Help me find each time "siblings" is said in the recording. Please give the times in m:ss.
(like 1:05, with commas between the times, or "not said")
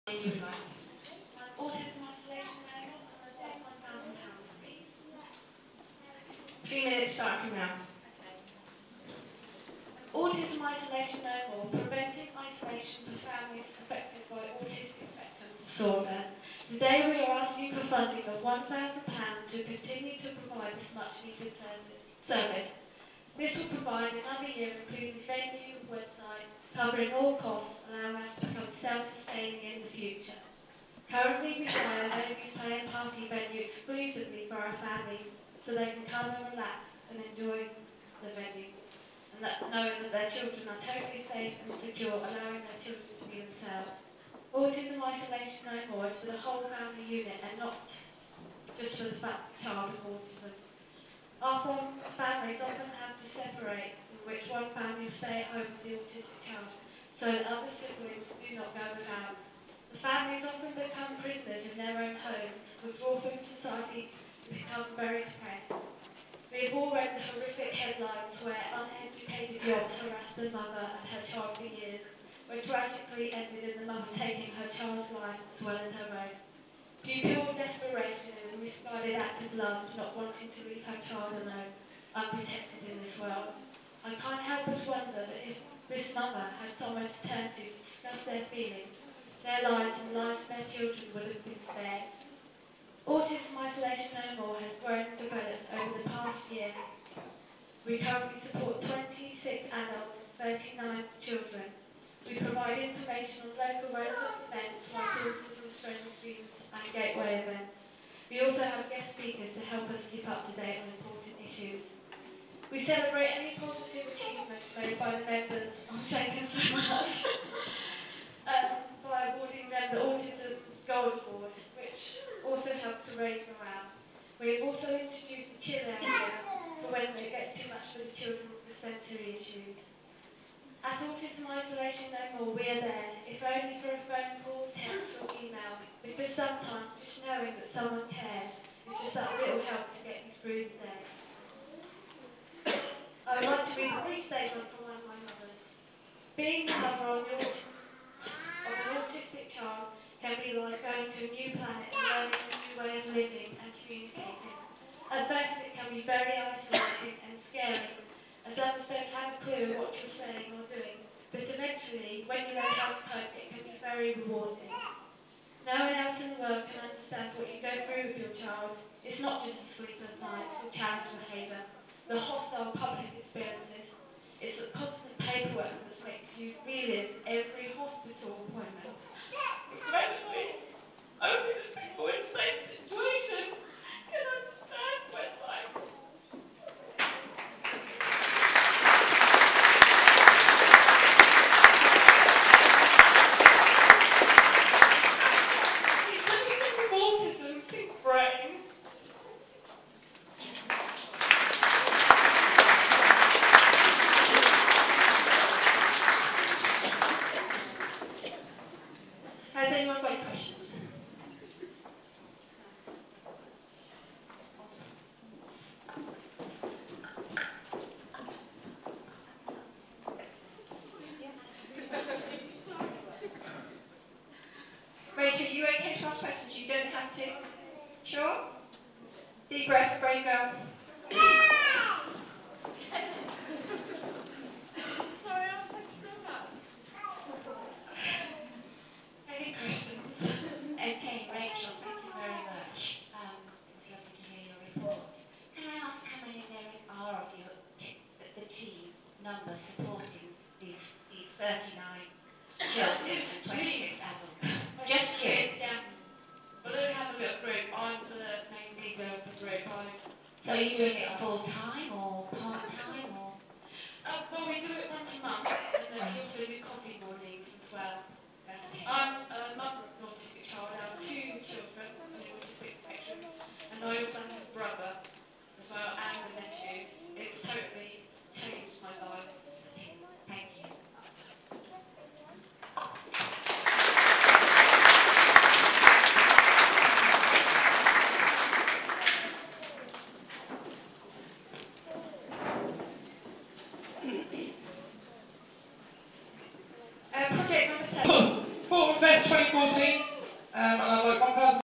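0:57.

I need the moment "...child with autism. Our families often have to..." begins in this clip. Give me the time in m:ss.
0:49.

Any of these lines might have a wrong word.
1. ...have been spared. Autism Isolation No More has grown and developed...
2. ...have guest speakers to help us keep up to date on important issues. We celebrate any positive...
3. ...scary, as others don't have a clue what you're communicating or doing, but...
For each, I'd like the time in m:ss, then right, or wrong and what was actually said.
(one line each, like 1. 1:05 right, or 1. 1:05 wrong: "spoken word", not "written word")
1. 1:31 right
2. 1:48 right
3. 2:37 wrong: "saying", not "communicating".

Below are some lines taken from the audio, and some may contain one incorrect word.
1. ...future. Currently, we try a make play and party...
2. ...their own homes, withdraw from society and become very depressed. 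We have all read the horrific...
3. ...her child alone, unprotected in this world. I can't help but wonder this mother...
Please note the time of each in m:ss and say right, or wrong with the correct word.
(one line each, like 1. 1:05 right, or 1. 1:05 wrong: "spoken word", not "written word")
1. 0:29 right
2. 1:01 right
3. 1:20 right.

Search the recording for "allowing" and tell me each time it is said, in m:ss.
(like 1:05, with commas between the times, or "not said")
0:27, 0:42.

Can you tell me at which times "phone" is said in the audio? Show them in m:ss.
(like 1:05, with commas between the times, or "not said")
2:14.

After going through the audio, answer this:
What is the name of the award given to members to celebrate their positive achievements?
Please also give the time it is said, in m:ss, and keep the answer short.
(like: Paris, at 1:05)
Autism Gold Award, at 1:59.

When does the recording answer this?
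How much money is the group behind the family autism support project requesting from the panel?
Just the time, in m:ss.
0:18.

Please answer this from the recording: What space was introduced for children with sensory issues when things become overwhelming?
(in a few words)
chill area.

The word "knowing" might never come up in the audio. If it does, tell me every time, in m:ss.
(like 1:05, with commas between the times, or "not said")
0:39, 2:17.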